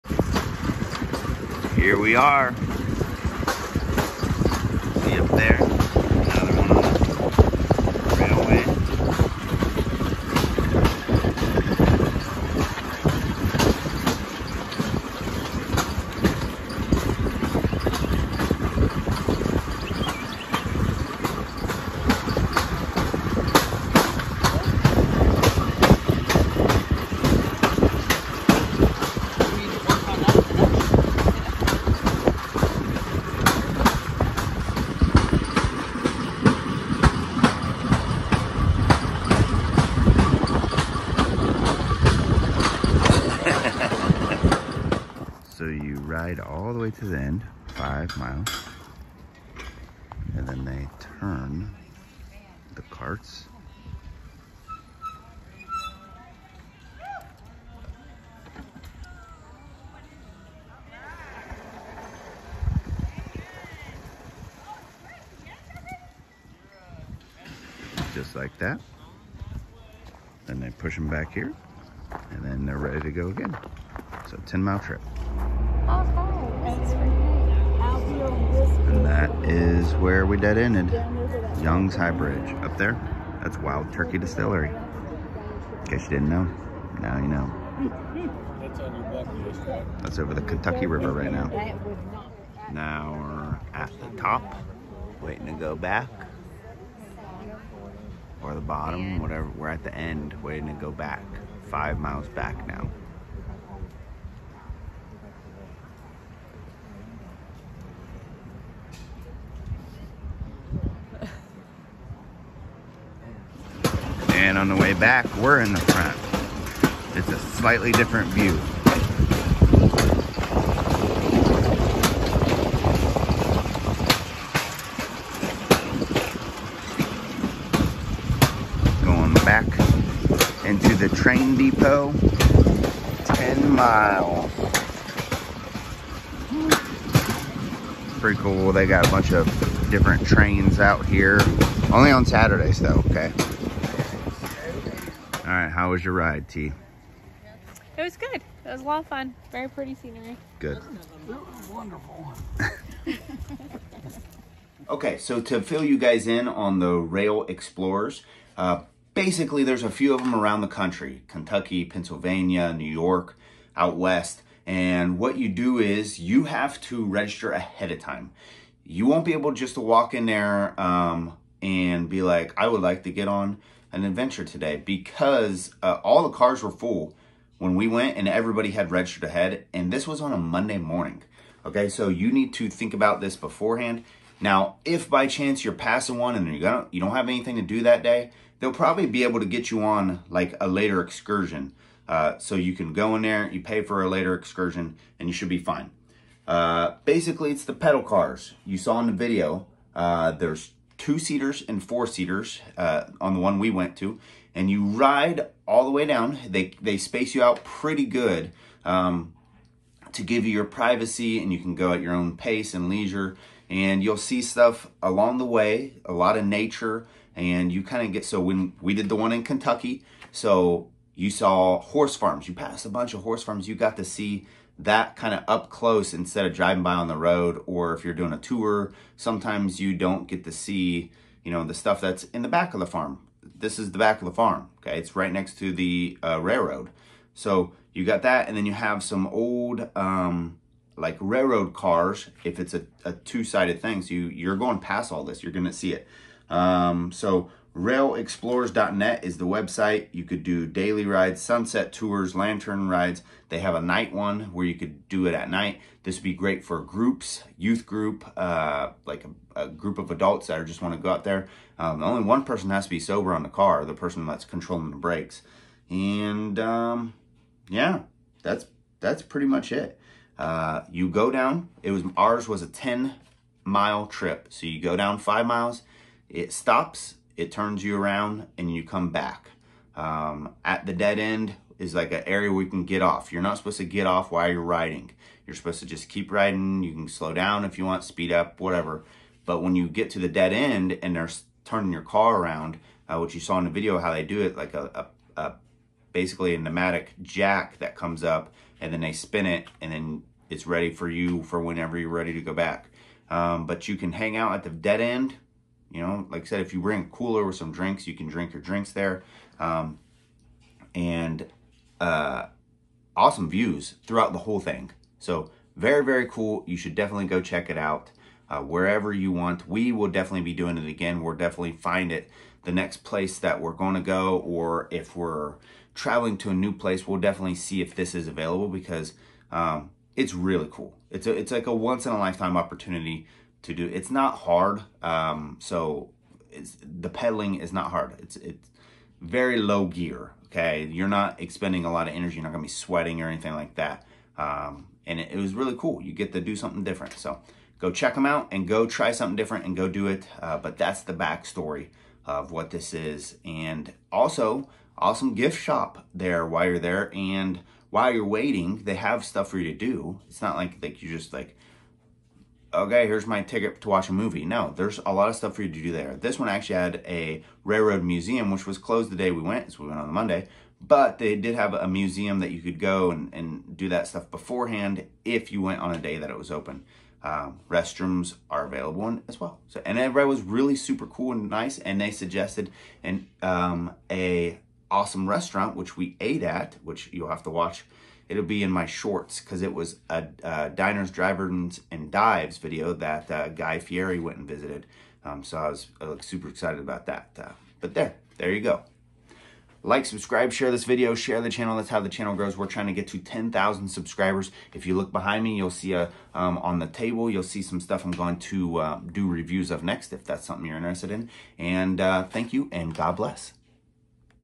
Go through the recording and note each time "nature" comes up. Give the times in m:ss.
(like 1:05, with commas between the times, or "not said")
3:36.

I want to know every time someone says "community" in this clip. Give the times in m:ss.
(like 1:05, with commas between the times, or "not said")
not said.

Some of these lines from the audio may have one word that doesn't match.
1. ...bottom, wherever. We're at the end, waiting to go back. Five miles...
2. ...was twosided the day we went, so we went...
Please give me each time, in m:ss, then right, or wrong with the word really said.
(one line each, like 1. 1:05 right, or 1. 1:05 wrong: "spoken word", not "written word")
1. 1:38 wrong: "whatever", not "wherever"
2. 6:08 wrong: "closed", not "twosided".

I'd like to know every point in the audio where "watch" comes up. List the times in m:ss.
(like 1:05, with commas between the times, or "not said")
6:03, 6:27.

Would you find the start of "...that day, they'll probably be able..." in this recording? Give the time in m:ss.
3:07.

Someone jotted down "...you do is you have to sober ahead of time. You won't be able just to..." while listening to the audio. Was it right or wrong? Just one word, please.
wrong.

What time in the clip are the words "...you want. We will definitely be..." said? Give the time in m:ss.
5:19.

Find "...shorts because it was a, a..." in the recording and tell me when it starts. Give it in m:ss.
6:28.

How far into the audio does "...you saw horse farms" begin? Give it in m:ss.
3:41.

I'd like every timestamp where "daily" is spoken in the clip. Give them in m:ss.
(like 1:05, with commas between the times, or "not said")
4:10.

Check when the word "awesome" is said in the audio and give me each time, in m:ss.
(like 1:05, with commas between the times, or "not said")
5:13, 5:54, 6:24.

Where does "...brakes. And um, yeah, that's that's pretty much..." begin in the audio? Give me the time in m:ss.
4:24.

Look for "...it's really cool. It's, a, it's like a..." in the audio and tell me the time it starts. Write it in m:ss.
5:30.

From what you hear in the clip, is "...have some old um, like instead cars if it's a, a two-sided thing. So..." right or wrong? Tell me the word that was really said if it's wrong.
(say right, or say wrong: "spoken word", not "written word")
wrong: "railroad", not "instead".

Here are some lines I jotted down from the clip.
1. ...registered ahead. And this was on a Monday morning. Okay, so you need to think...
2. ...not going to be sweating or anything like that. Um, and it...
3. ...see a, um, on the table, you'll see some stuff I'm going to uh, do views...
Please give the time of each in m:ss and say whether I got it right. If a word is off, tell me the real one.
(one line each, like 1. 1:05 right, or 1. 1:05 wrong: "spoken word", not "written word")
1. 2:58 right
2. 5:42 right
3. 6:45 wrong: "reviews", not "views".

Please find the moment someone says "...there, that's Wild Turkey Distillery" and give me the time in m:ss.
1:22.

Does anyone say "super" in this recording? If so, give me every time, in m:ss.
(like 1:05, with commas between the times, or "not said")
6:20, 6:36.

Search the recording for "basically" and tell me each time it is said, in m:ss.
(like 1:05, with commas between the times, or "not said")
2:39, 3:17, 4:56.